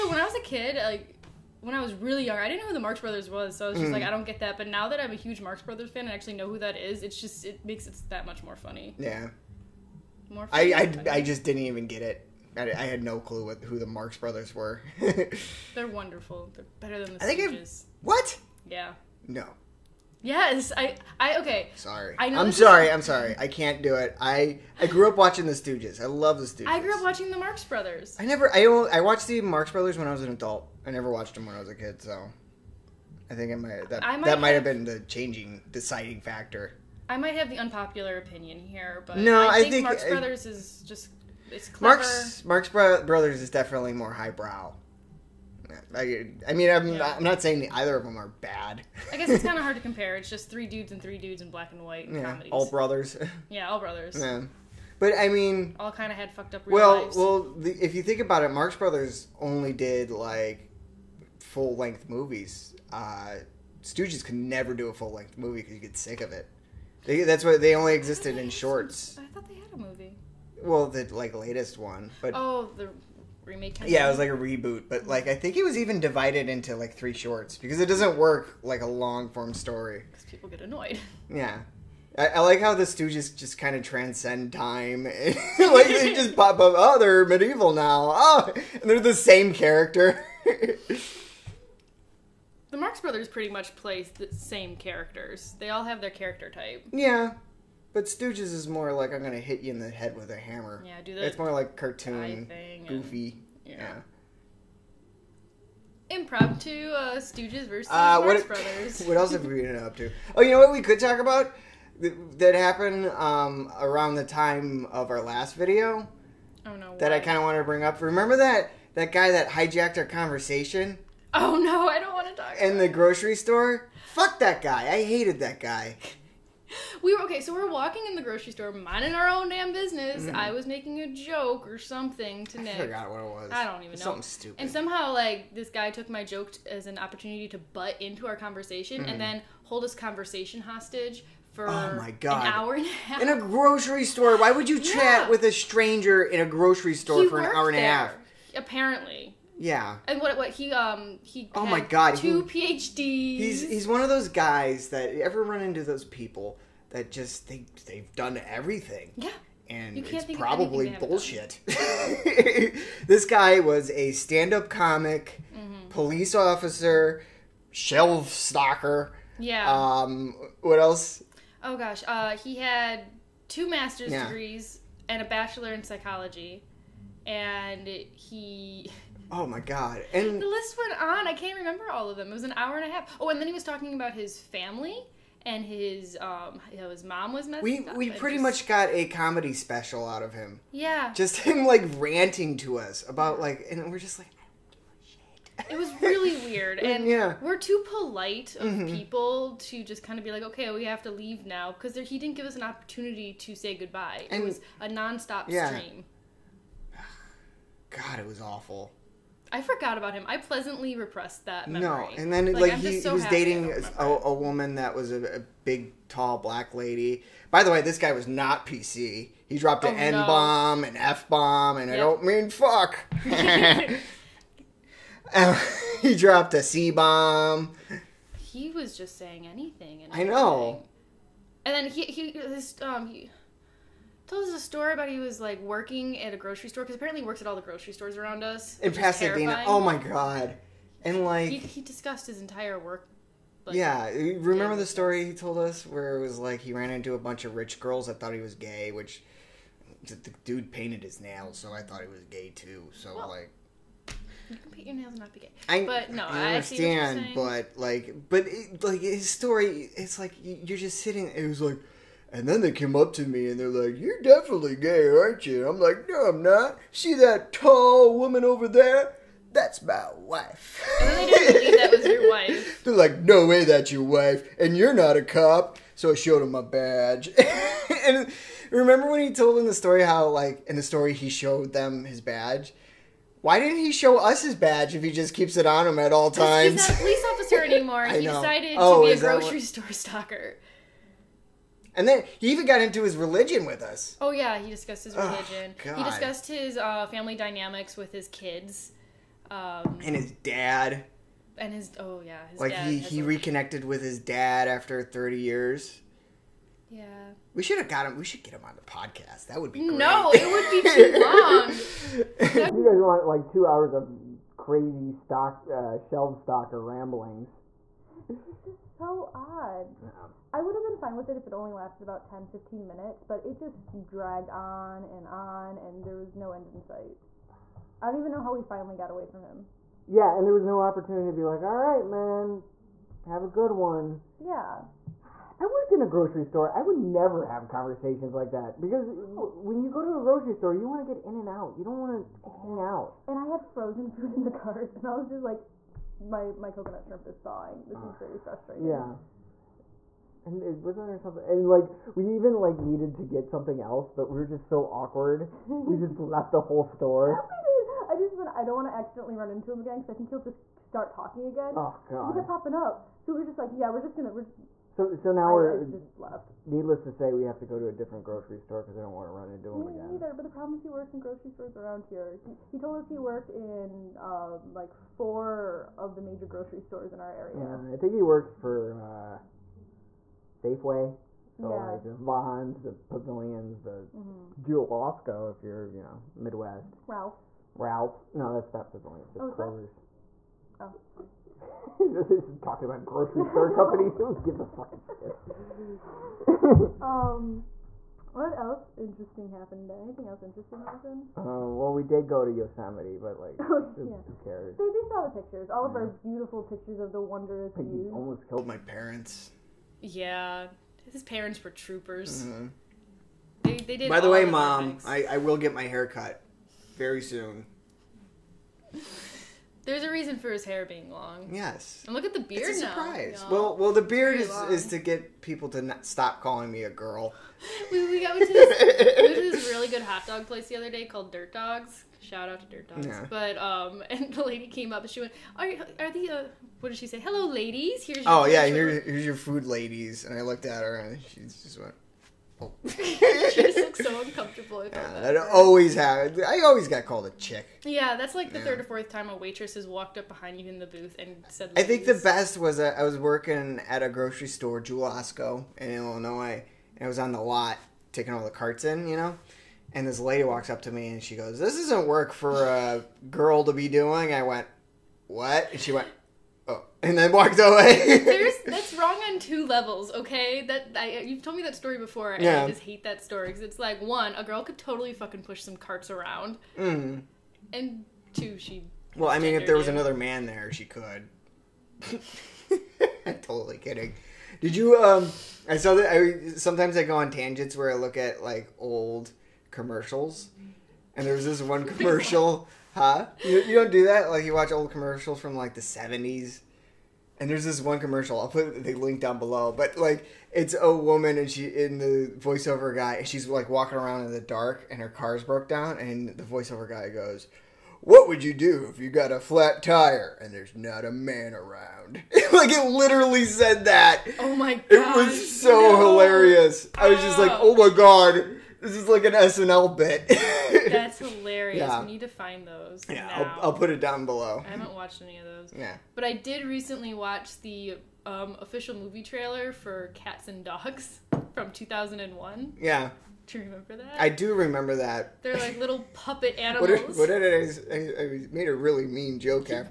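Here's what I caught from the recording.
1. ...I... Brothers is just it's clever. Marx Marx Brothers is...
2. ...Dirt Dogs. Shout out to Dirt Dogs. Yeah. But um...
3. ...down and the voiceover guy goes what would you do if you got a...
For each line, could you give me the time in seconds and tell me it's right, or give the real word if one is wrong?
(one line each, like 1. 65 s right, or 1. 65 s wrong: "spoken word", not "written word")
1. 40 s right
2. 431 s right
3. 505 s right.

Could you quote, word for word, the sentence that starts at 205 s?
stream god it was awful I forgot about him.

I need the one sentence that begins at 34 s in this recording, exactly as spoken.
might have been the changing deciding factor.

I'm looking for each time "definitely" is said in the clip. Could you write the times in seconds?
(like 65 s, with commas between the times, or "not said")
43 s, 264 s.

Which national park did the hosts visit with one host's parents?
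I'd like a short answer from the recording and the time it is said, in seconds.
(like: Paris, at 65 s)
Yosemite, at 402 s.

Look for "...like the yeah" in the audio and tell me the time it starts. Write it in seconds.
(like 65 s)
448 s.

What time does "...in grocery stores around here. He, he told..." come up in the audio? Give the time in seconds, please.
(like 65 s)
371 s.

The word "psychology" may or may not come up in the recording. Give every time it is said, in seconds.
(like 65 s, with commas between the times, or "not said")
175 s.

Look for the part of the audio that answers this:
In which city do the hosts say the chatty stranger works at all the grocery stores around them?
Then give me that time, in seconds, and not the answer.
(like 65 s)
238 s.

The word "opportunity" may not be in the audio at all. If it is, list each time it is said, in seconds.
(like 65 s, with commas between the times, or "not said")
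136 s, 202 s, 330 s.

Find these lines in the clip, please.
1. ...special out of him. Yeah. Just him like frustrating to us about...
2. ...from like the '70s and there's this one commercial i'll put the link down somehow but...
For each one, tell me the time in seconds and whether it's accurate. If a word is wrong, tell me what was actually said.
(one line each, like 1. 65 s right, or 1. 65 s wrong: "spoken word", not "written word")
1. 189 s wrong: "ranting", not "frustrating"
2. 495 s wrong: "below", not "somehow".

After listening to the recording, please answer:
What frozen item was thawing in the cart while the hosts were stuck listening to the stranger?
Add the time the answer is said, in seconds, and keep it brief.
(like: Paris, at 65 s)
Coconut shrimp, at 346 s.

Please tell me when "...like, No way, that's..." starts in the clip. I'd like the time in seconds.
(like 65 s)
272 s.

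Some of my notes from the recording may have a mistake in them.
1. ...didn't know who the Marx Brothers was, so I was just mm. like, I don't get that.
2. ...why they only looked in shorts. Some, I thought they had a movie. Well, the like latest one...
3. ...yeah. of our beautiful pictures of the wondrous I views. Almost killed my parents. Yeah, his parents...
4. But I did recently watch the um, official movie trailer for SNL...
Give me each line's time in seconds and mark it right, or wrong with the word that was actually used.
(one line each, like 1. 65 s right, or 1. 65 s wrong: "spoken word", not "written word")
1. 2 s right
2. 67 s wrong: "existed", not "looked"
3. 405 s right
4. 526 s wrong: "Cats", not "SNL".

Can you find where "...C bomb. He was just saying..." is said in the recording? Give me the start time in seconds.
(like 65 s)
226 s.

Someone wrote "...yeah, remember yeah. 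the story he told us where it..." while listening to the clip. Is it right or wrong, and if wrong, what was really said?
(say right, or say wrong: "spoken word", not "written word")
right.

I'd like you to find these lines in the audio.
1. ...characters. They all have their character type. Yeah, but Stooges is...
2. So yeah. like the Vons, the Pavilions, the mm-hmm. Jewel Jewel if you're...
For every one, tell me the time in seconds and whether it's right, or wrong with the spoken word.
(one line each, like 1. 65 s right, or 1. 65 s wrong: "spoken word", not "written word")
1. 94 s right
2. 381 s wrong: "Osco", not "Jewel".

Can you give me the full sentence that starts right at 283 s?
Why didn't he show us his badge if he just keeps it on him at all times?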